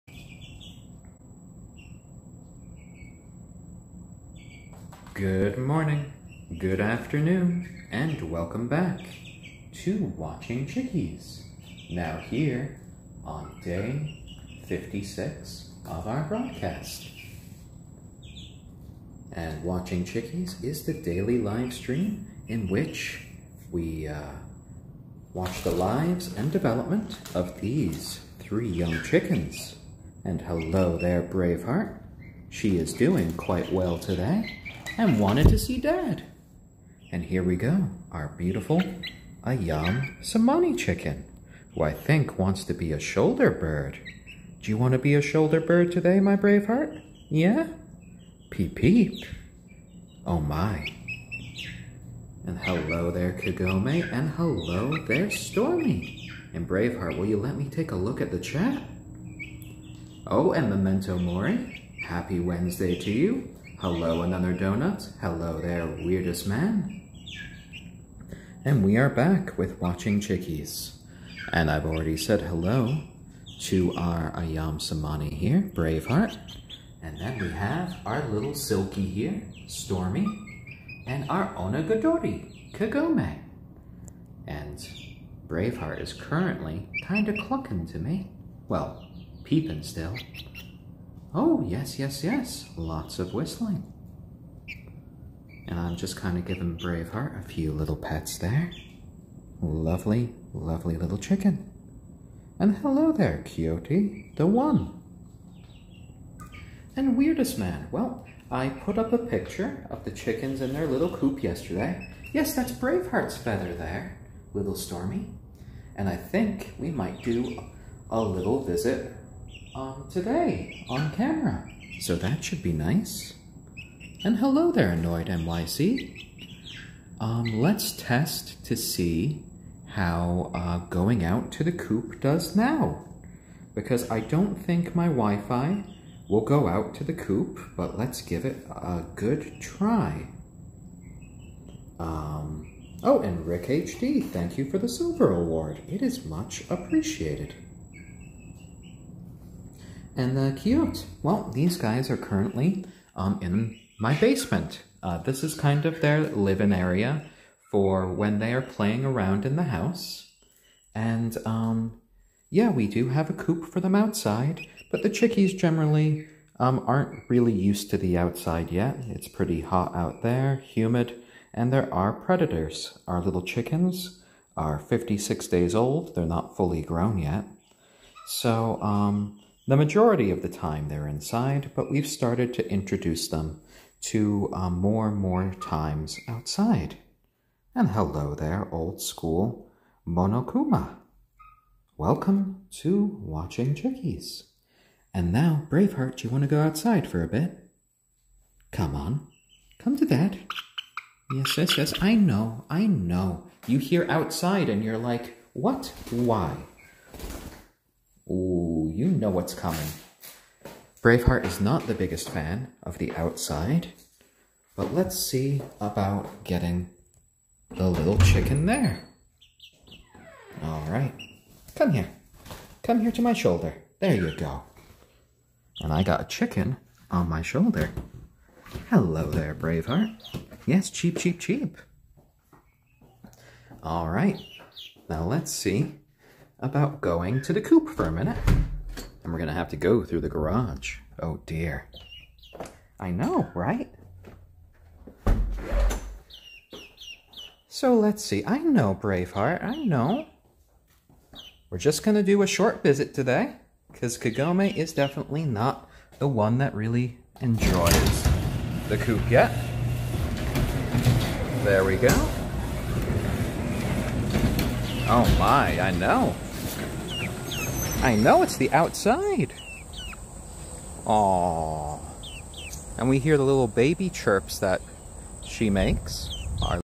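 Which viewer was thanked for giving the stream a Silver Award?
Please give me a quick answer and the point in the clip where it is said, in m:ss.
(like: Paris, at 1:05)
Rick HD, at 2:23.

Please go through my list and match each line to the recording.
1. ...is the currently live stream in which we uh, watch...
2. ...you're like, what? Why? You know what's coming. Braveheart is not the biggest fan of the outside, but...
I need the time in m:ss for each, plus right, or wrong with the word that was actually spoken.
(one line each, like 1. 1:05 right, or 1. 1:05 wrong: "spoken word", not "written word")
1. 0:20 wrong: "daily", not "currently"
2. 3:24 right.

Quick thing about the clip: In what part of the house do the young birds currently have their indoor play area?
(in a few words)
basement.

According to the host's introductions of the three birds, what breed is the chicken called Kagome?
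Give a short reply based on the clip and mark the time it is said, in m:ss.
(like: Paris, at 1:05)
Onagadori, at 1:21.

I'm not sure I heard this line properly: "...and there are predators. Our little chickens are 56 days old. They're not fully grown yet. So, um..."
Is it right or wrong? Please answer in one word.
right.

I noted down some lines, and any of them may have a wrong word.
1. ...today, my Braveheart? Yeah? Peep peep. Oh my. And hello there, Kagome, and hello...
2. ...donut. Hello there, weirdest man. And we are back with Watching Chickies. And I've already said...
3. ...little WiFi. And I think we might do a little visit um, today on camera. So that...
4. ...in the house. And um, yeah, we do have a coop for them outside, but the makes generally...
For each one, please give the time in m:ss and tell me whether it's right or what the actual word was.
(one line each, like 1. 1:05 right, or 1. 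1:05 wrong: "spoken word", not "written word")
1. 0:45 right
2. 1:04 right
3. 1:54 wrong: "Stormy", not "WiFi"
4. 2:39 wrong: "chickies", not "makes".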